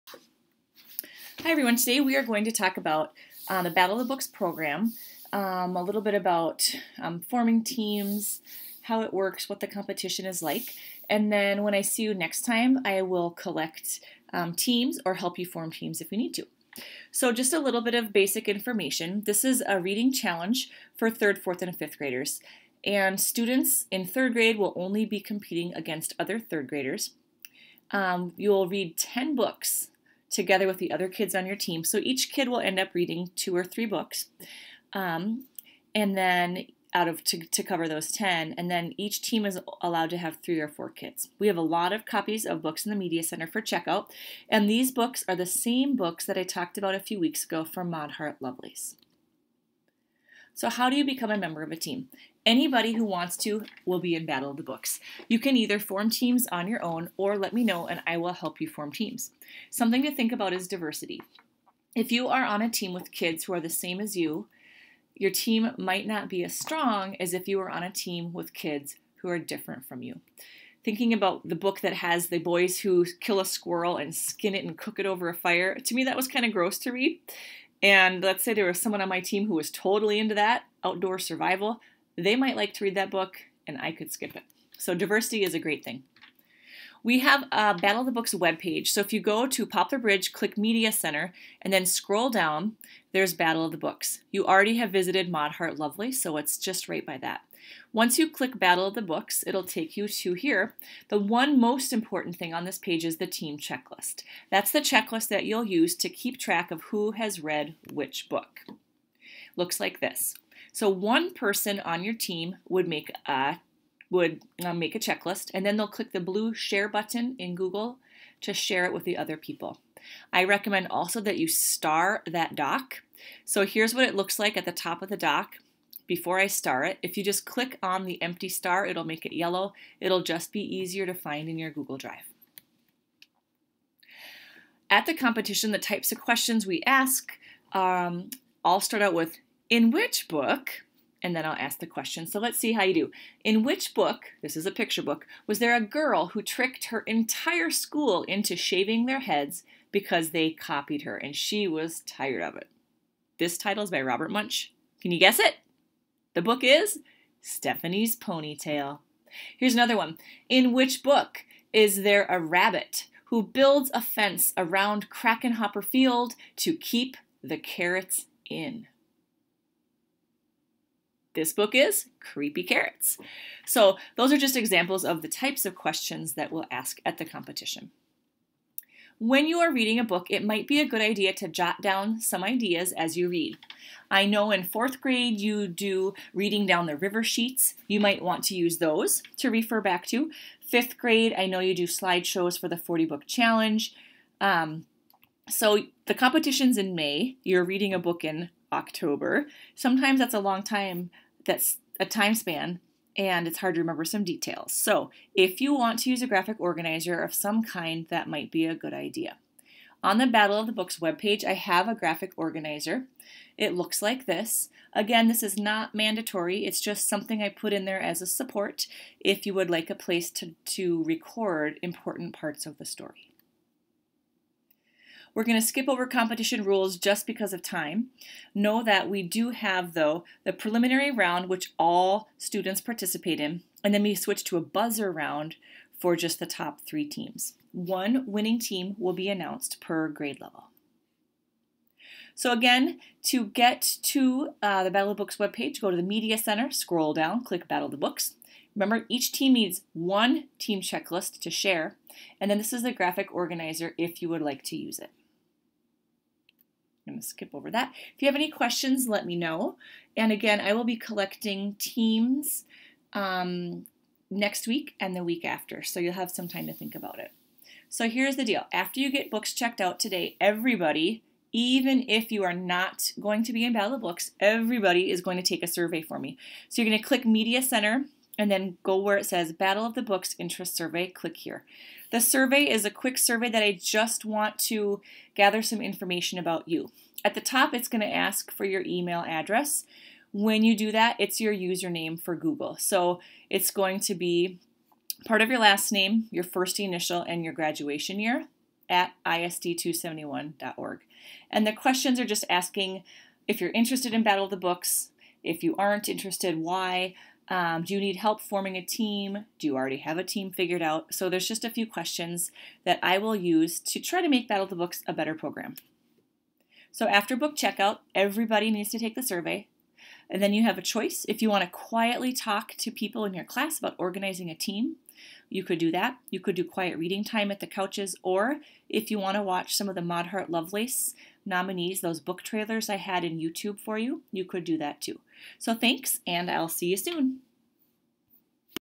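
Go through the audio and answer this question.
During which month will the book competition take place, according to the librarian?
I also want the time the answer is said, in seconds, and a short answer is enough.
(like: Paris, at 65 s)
May, at 196 s.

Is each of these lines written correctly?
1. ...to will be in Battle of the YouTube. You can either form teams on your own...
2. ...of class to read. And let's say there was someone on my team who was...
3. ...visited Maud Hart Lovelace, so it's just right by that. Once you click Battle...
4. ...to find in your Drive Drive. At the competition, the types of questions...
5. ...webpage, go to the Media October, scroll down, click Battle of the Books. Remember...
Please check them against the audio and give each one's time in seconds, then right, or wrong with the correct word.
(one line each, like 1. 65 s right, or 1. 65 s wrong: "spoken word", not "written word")
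1. 53 s wrong: "Books", not "YouTube"
2. 76 s wrong: "gross", not "class"
3. 94 s right
4. 131 s wrong: "Google", not "Drive"
5. 245 s wrong: "Center", not "October".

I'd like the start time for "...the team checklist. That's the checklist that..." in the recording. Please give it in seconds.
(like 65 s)
103 s.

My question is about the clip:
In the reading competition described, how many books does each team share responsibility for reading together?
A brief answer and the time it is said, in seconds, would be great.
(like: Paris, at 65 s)
10, at 28 s.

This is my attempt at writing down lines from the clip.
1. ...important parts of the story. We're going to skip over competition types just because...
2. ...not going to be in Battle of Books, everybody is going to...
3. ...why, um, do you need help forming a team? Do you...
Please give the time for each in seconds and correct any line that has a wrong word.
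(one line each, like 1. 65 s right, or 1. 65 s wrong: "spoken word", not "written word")
1. 221 s wrong: "rules", not "types"
2. 272 s right
3. 306 s right.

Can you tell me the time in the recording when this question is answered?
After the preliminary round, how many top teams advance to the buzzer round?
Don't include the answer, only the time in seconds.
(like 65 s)
236 s.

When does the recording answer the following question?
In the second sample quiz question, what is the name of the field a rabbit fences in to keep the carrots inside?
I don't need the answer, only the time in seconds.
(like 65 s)
165 s.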